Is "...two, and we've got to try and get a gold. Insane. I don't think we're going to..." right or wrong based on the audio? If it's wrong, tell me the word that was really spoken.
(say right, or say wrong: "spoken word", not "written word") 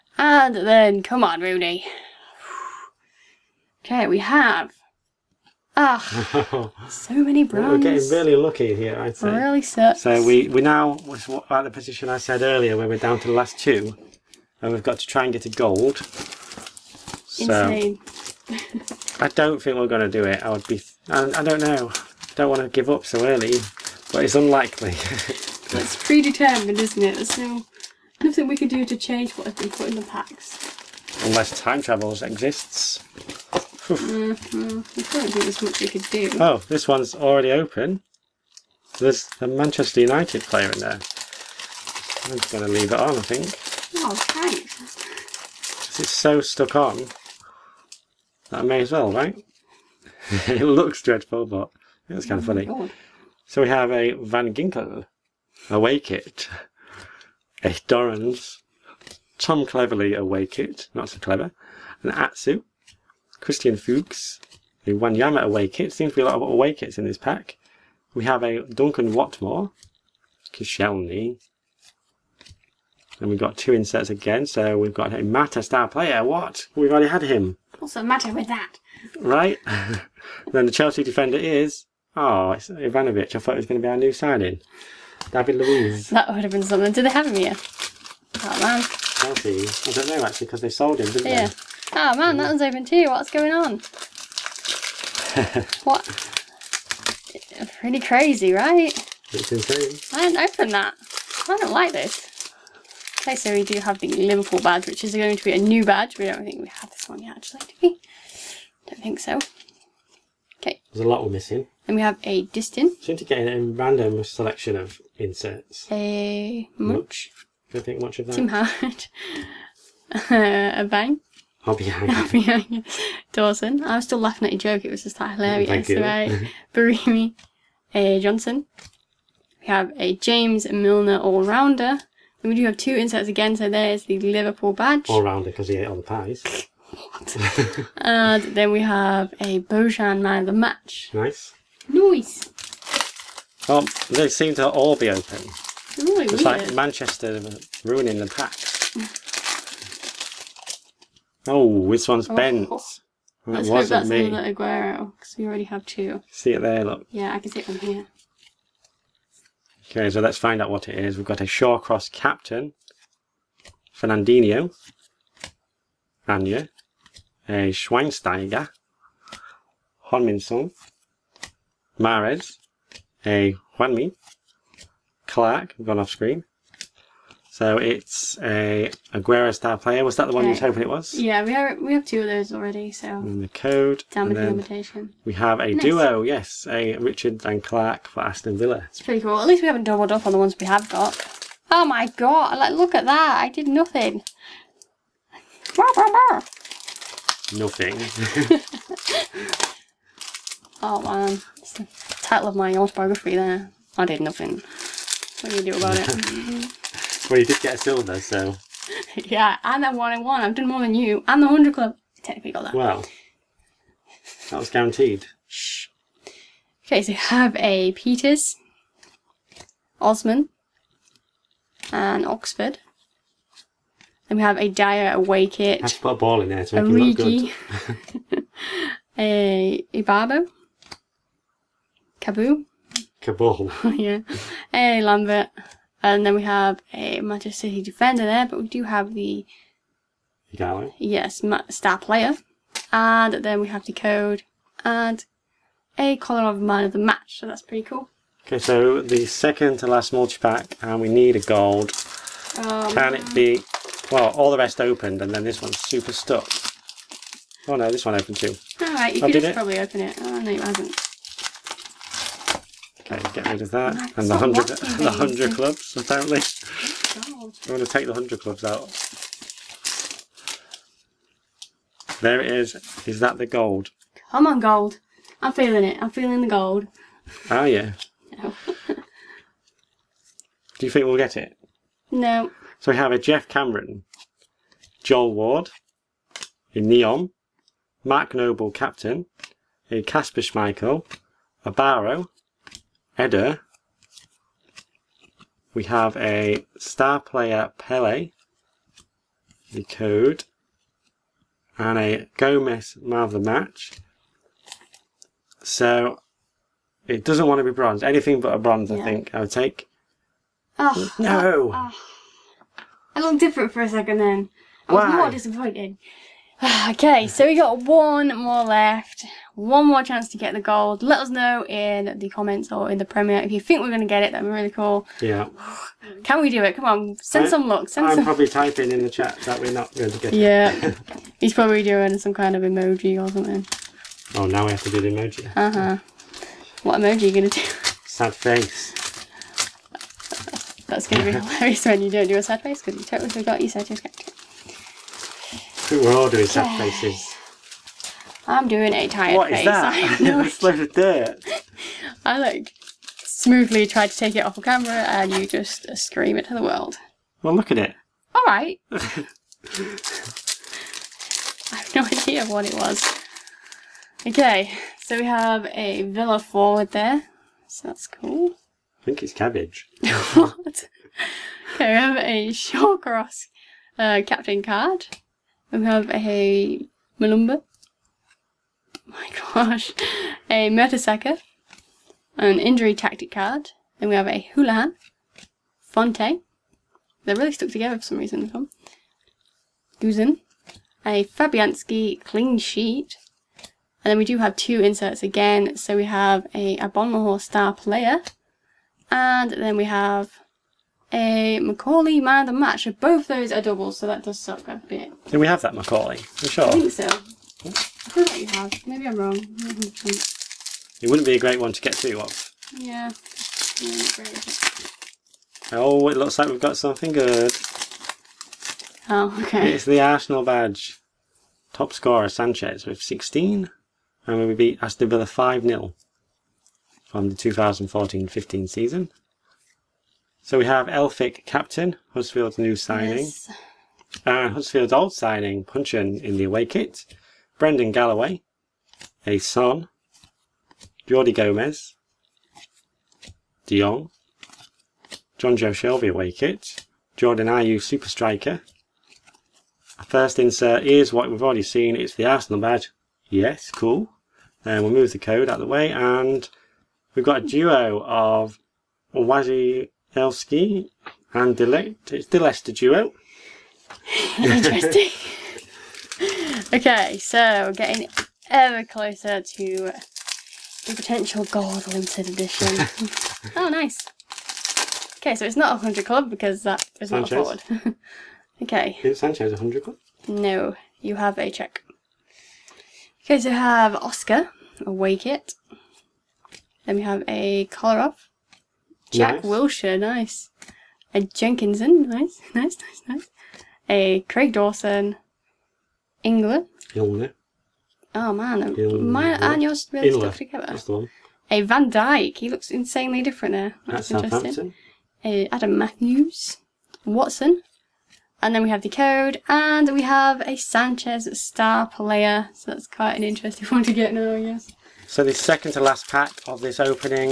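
right.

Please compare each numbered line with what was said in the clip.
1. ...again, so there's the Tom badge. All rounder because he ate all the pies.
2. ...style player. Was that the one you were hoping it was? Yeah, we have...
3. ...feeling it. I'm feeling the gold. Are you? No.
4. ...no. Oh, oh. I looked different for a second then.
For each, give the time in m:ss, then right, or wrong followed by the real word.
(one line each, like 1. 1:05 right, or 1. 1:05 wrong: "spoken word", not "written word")
1. 2:13 wrong: "Liverpool", not "Tom"
2. 2:59 right
3. 4:35 right
4. 5:11 right.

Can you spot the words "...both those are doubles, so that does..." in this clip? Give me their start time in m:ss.
6:42.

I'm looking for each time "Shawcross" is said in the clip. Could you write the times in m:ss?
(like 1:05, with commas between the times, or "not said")
2:41, 6:12.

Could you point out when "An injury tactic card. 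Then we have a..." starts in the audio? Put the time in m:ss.
6:22.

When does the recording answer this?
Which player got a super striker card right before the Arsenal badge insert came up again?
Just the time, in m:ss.
7:27.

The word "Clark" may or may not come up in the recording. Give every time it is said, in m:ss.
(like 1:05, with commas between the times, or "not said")
2:55, 3:07.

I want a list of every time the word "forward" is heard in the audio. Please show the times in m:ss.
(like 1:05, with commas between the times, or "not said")
6:06, 7:57.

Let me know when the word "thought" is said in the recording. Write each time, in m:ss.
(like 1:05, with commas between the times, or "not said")
1:23.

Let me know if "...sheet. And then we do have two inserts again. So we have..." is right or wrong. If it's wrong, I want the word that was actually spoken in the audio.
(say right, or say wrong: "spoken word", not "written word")
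right.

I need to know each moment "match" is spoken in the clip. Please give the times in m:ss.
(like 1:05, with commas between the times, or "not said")
2:20, 4:06, 5:03, 6:42.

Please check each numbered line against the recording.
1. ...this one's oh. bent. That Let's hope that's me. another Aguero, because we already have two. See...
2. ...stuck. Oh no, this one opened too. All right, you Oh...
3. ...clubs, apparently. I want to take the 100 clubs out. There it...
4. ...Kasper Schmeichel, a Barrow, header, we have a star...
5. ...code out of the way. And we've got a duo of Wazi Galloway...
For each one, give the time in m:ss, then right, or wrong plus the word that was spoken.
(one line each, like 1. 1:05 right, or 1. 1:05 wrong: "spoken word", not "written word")
1. 2:31 right
2. 4:16 right
3. 4:25 right
4. 4:50 right
5. 7:35 wrong: "Elski", not "Galloway".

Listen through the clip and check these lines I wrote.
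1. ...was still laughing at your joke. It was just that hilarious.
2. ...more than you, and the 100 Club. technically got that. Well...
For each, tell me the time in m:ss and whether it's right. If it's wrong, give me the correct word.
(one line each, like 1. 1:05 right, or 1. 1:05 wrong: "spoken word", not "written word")
1. 2:03 right
2. 3:30 right.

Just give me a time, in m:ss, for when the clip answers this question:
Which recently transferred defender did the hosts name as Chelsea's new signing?
1:25.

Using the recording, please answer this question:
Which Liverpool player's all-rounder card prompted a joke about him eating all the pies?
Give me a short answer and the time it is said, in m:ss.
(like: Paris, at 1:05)
James Milner, at 2:10.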